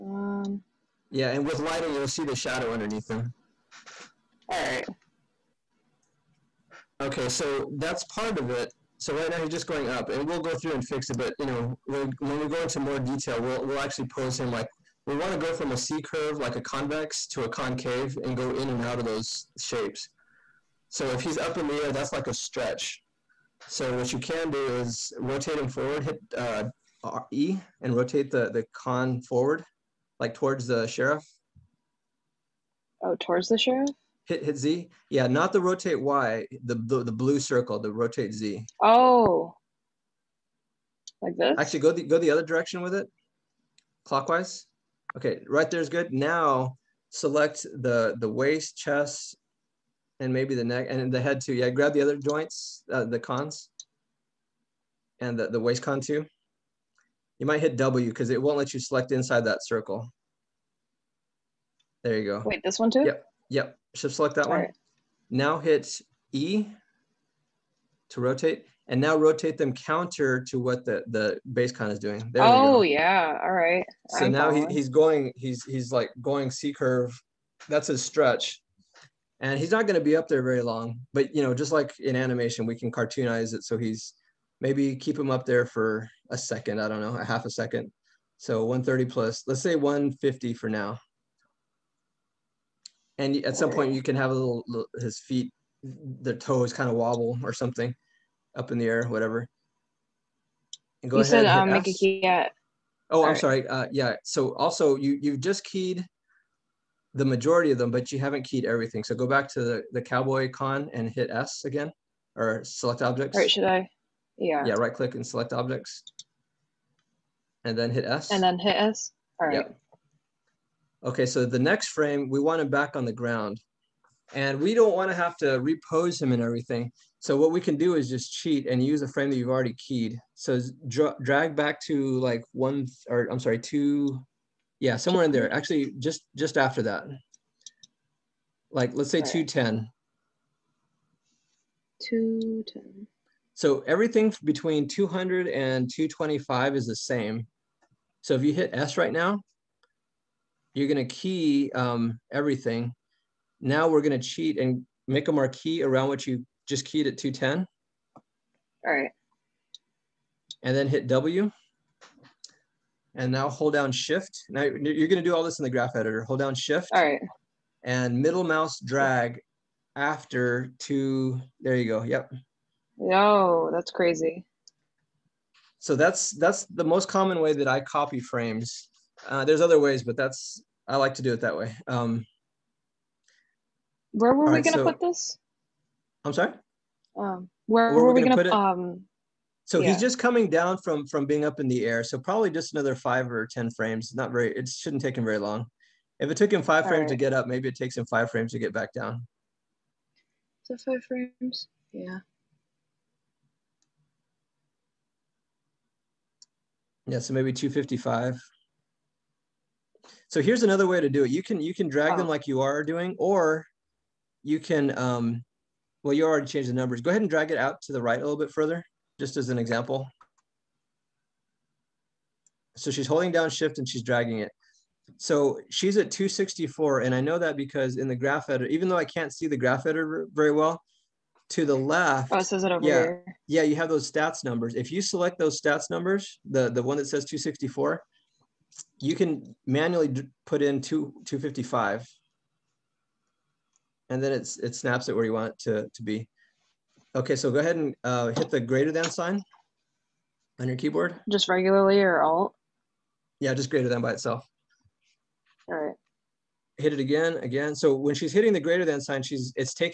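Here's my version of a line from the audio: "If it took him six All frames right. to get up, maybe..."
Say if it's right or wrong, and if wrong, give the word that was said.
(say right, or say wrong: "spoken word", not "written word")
wrong: "five", not "six".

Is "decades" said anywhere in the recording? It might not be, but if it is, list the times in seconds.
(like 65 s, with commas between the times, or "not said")
not said.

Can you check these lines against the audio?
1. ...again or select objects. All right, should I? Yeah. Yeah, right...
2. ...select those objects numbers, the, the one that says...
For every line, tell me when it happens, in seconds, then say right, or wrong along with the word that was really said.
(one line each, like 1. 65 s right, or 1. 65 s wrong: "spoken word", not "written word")
1. 111 s right
2. 235 s wrong: "stats", not "objects".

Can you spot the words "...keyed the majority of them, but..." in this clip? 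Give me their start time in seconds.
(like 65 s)
105 s.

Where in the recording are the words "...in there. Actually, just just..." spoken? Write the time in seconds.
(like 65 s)
135 s.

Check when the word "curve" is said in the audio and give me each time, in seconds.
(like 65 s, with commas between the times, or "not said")
16 s, 76 s.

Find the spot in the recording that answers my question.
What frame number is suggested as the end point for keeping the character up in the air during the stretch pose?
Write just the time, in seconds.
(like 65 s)
89 s.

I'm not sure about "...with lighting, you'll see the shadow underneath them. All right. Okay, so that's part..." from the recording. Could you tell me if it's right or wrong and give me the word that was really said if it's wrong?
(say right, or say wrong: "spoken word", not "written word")
right.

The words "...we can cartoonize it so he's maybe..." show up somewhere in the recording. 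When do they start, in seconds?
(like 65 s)
82 s.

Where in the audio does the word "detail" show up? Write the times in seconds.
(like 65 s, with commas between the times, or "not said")
12 s.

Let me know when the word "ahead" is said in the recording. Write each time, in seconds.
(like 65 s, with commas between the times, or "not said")
101 s, 217 s, 247 s.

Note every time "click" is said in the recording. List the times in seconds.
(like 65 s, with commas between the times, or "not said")
114 s.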